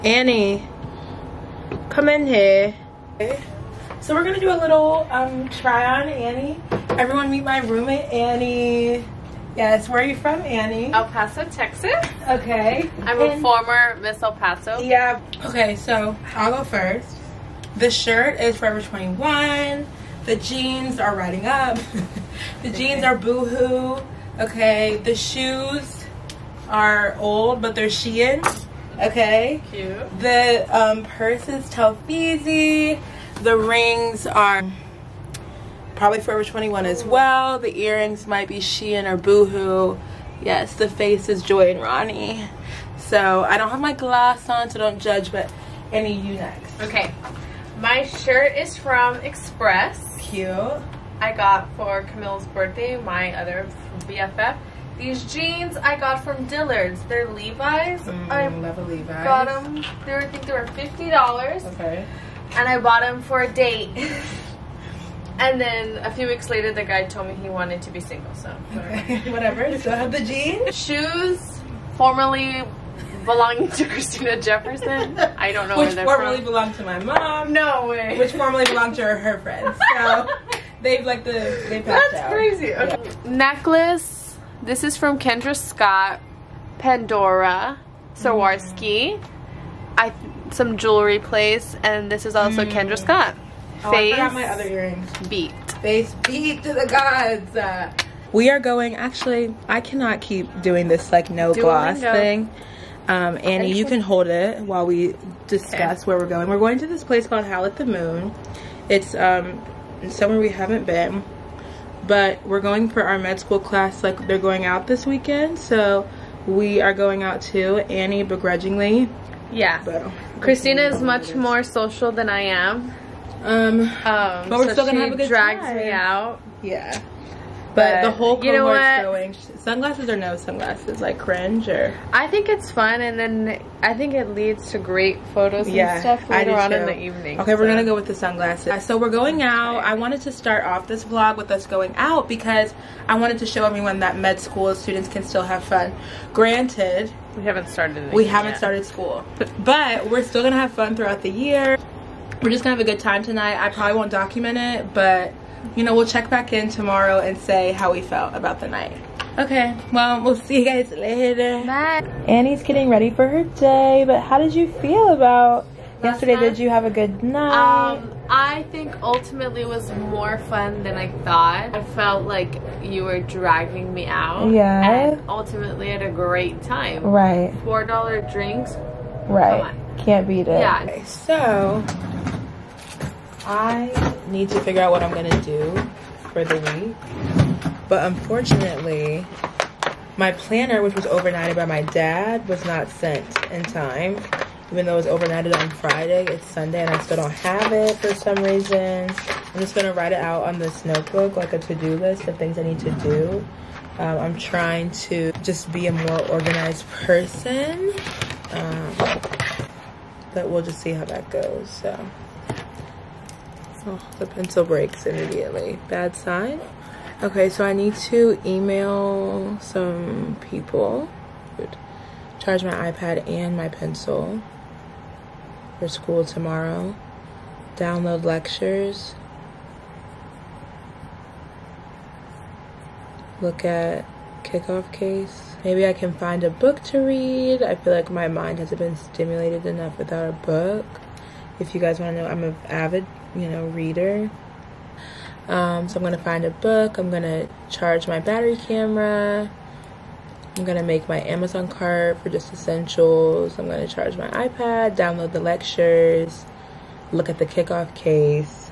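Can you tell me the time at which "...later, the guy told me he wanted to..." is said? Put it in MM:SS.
01:06.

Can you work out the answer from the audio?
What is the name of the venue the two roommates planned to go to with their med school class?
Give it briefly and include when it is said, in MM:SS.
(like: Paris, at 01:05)
Howl at the Moon, at 01:47.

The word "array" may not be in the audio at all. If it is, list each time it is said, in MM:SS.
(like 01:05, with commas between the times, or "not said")
not said.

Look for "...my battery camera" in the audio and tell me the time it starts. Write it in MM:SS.
04:08.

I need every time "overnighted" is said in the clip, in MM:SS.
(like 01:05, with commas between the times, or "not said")
03:11, 03:15.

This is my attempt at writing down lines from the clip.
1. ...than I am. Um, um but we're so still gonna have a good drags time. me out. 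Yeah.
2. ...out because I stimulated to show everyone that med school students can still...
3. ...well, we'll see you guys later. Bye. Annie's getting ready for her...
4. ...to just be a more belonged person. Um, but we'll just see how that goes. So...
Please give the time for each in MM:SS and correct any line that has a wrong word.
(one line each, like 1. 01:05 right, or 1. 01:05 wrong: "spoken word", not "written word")
1. 02:02 right
2. 02:21 wrong: "wanted", not "stimulated"
3. 02:39 right
4. 03:25 wrong: "organized", not "belonged".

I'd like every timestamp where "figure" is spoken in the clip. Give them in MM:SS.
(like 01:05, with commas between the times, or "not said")
03:04.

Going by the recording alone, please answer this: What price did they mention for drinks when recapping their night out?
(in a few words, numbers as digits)
$4.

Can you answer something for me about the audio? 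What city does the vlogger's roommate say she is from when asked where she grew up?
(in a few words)
El Paso, Texas.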